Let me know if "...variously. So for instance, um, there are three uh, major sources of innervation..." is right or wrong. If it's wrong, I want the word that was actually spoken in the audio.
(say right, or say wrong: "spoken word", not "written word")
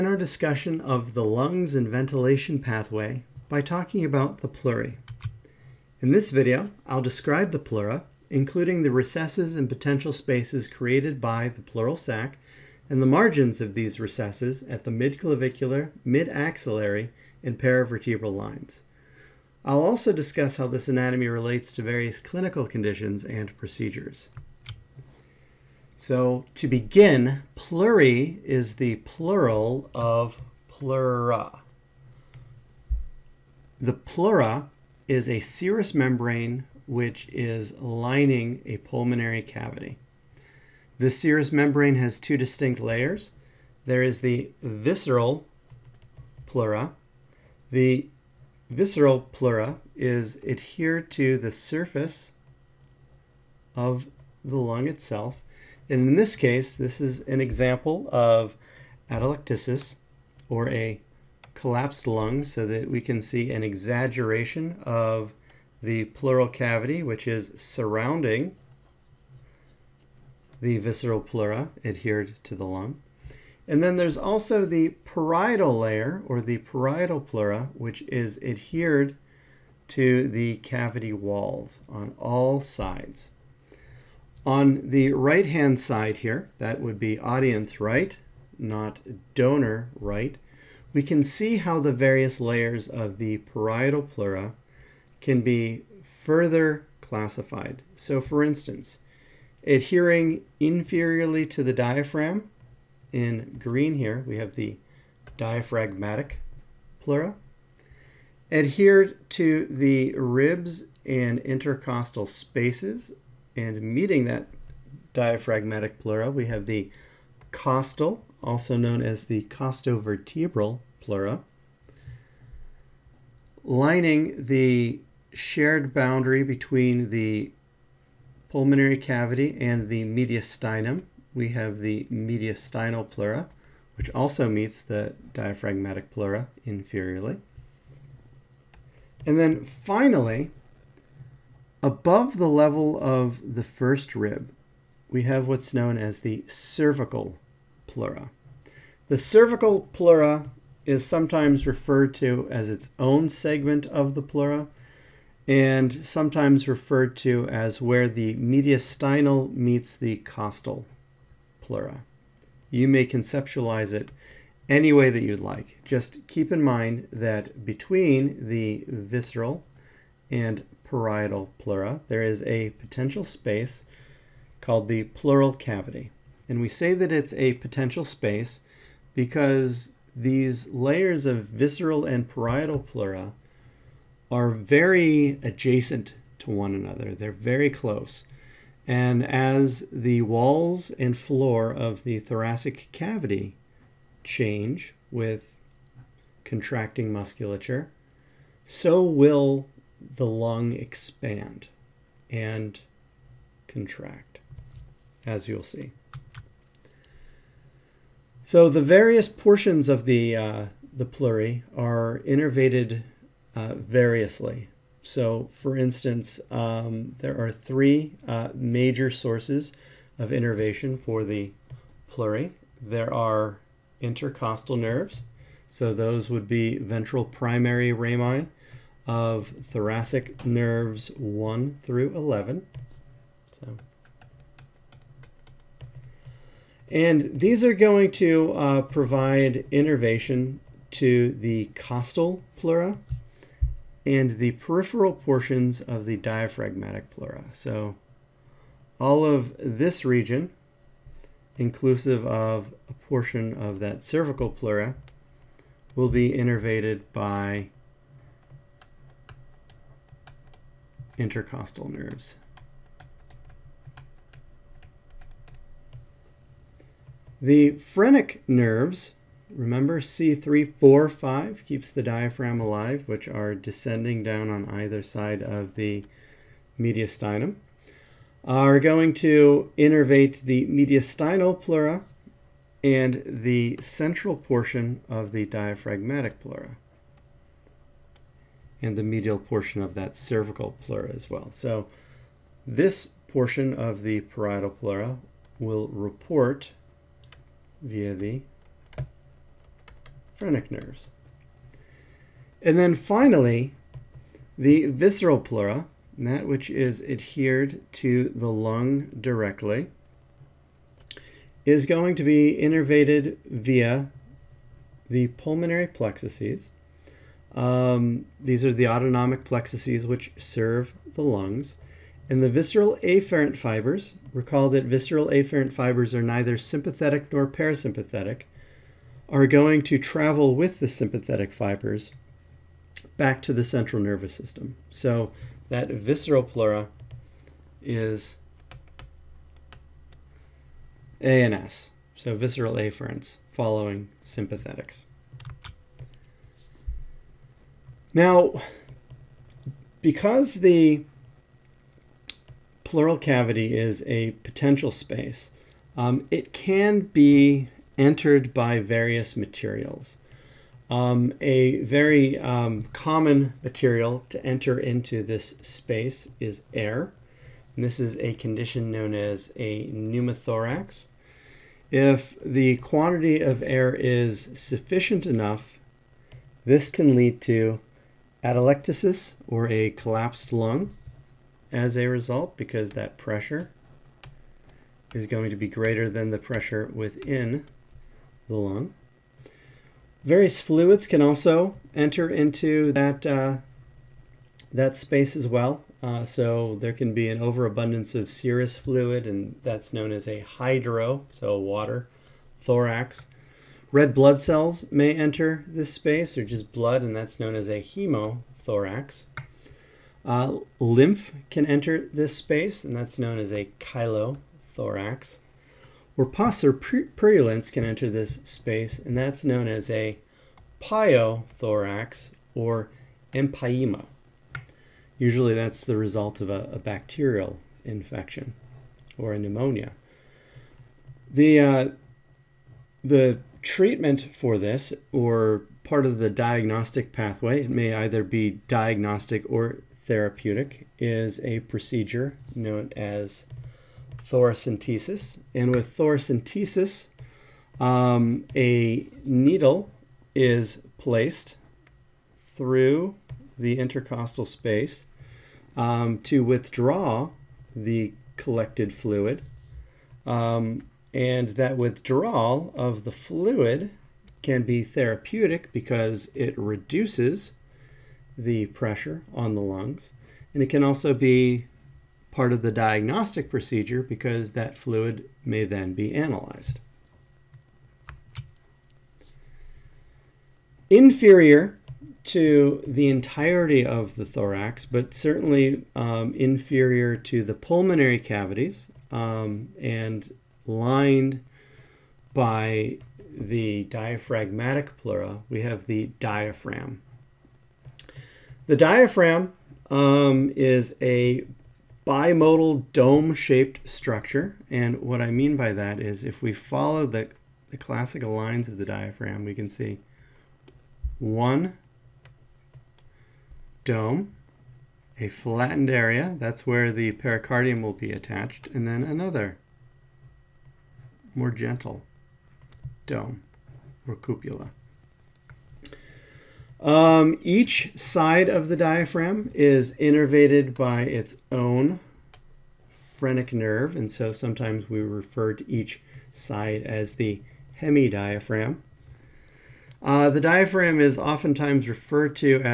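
right.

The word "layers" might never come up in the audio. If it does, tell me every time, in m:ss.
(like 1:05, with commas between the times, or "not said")
0:42, 1:15, 1:32, 3:00.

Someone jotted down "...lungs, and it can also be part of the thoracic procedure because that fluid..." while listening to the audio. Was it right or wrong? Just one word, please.
wrong.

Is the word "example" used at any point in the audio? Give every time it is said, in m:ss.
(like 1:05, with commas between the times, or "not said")
0:57.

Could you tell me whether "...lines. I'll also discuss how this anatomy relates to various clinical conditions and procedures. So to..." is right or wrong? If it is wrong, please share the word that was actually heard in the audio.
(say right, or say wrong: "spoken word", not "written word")
right.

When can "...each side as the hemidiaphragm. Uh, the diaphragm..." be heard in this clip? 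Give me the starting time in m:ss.
8:55.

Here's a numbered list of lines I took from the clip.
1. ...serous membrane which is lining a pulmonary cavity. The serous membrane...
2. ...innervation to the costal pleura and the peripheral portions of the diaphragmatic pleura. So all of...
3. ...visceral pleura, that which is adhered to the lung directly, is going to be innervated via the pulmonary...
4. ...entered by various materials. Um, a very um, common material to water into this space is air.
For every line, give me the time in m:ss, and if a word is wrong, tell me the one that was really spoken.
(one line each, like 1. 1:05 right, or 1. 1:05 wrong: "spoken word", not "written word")
1. 0:35 right
2. 3:59 right
3. 5:04 right
4. 5:57 wrong: "enter", not "water".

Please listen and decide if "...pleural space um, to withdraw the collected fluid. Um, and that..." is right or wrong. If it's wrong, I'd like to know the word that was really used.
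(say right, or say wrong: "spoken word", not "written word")
wrong: "intercostal", not "pleural".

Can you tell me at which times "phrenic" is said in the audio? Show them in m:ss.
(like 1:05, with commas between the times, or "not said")
4:27, 5:00, 8:52.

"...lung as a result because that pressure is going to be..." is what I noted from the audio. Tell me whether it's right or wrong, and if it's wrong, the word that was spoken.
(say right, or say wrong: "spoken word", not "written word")
right.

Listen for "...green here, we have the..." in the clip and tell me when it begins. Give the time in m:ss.
1:43.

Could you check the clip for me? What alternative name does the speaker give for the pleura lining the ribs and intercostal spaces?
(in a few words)
Costovertebral pleura.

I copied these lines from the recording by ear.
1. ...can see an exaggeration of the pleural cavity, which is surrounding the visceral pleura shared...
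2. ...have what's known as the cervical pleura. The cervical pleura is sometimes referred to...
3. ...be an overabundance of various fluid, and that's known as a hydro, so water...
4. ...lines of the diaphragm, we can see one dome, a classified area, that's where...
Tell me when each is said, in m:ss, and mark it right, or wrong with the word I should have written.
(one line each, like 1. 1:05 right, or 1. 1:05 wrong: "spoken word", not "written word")
1. 1:02 wrong: "adhered", not "shared"
2. 2:25 right
3. 6:37 wrong: "serous", not "various"
4. 8:28 wrong: "flattened", not "classified".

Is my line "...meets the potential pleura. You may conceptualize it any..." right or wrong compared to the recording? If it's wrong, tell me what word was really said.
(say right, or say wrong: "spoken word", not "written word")
wrong: "costal", not "potential".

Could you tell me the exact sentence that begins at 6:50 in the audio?
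Uh, lymph can enter this space, and that's known as a chylothorax.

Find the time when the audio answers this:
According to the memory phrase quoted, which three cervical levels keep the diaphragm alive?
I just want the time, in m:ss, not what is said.
4:29.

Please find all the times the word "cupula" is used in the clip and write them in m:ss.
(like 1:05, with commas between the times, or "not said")
8:44.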